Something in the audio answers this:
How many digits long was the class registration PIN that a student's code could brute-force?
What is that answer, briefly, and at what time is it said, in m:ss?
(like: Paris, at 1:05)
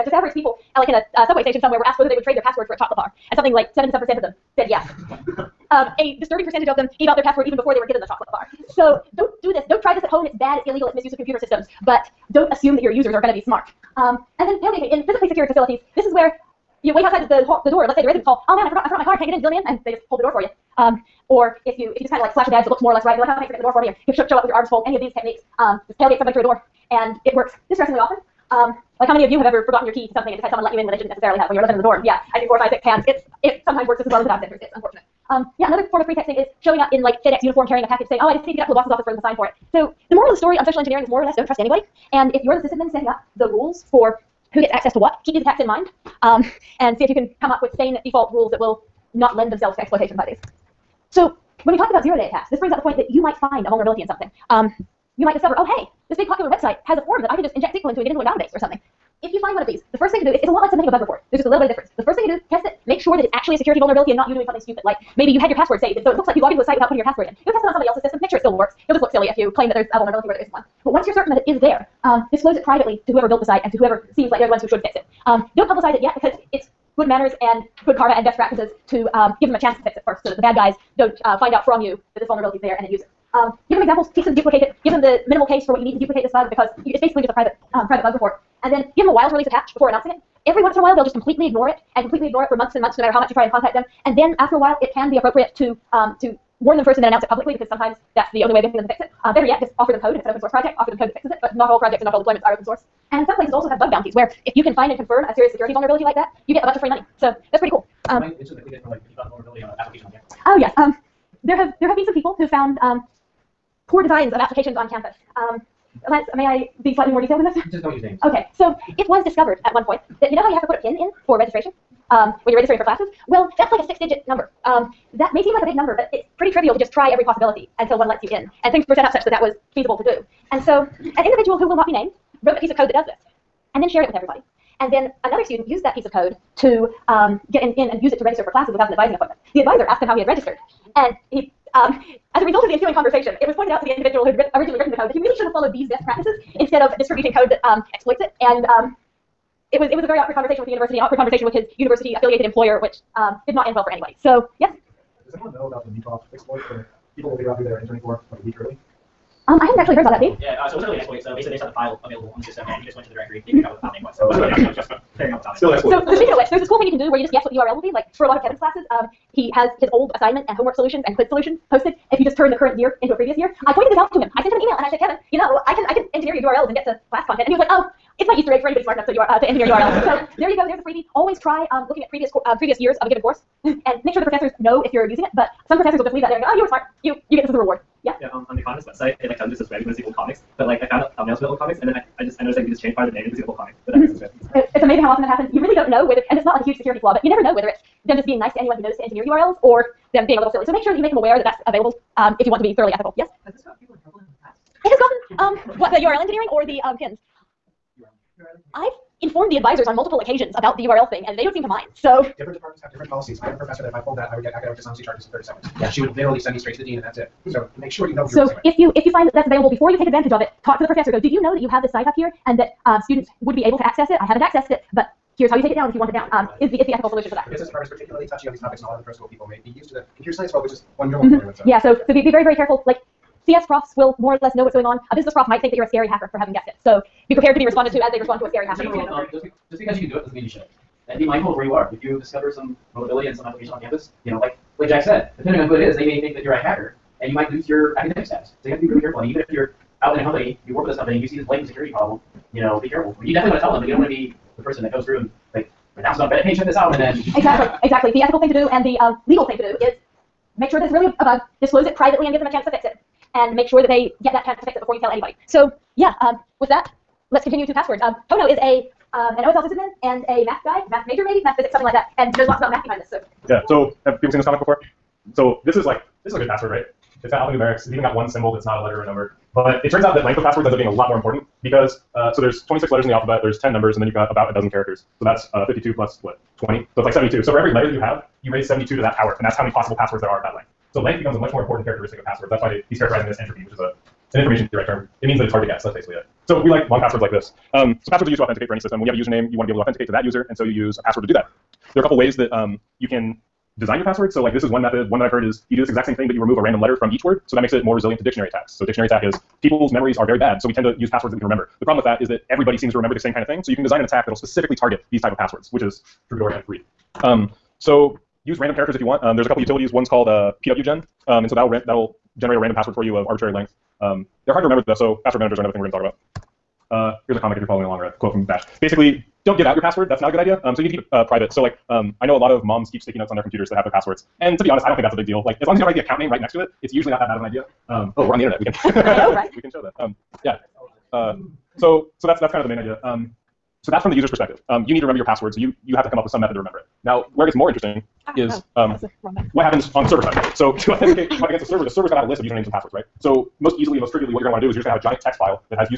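6, at 2:03.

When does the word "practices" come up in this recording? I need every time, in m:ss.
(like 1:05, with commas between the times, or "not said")
1:18, 2:26.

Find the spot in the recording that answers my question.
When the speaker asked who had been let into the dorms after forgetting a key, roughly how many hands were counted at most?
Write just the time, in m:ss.
0:32.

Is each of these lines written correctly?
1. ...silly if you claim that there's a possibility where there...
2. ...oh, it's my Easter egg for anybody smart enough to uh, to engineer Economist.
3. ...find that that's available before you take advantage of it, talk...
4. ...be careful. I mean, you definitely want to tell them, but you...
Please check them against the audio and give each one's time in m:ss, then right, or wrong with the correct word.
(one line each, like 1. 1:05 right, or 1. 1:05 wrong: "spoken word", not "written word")
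1. 1:09 wrong: "vulnerability", not "possibility"
2. 2:57 wrong: "URLs", not "Economist"
3. 3:39 right
4. 4:12 right.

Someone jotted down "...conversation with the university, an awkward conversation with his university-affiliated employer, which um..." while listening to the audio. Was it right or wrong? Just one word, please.
right.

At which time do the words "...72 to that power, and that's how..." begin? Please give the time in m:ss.
4:48.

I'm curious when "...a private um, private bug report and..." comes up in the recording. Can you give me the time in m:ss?
1:27.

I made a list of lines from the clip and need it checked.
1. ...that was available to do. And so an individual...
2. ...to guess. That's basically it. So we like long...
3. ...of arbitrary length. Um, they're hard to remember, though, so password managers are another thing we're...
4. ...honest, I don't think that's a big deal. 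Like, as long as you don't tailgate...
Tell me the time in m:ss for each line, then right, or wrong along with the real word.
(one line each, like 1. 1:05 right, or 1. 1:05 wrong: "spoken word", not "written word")
1. 2:09 wrong: "feasible", not "available"
2. 4:55 right
3. 5:23 right
4. 5:34 wrong: "write", not "tailgate".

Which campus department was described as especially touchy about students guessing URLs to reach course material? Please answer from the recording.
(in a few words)
business department.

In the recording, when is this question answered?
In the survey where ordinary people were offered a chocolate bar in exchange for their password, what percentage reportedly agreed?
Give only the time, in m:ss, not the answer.
0:03.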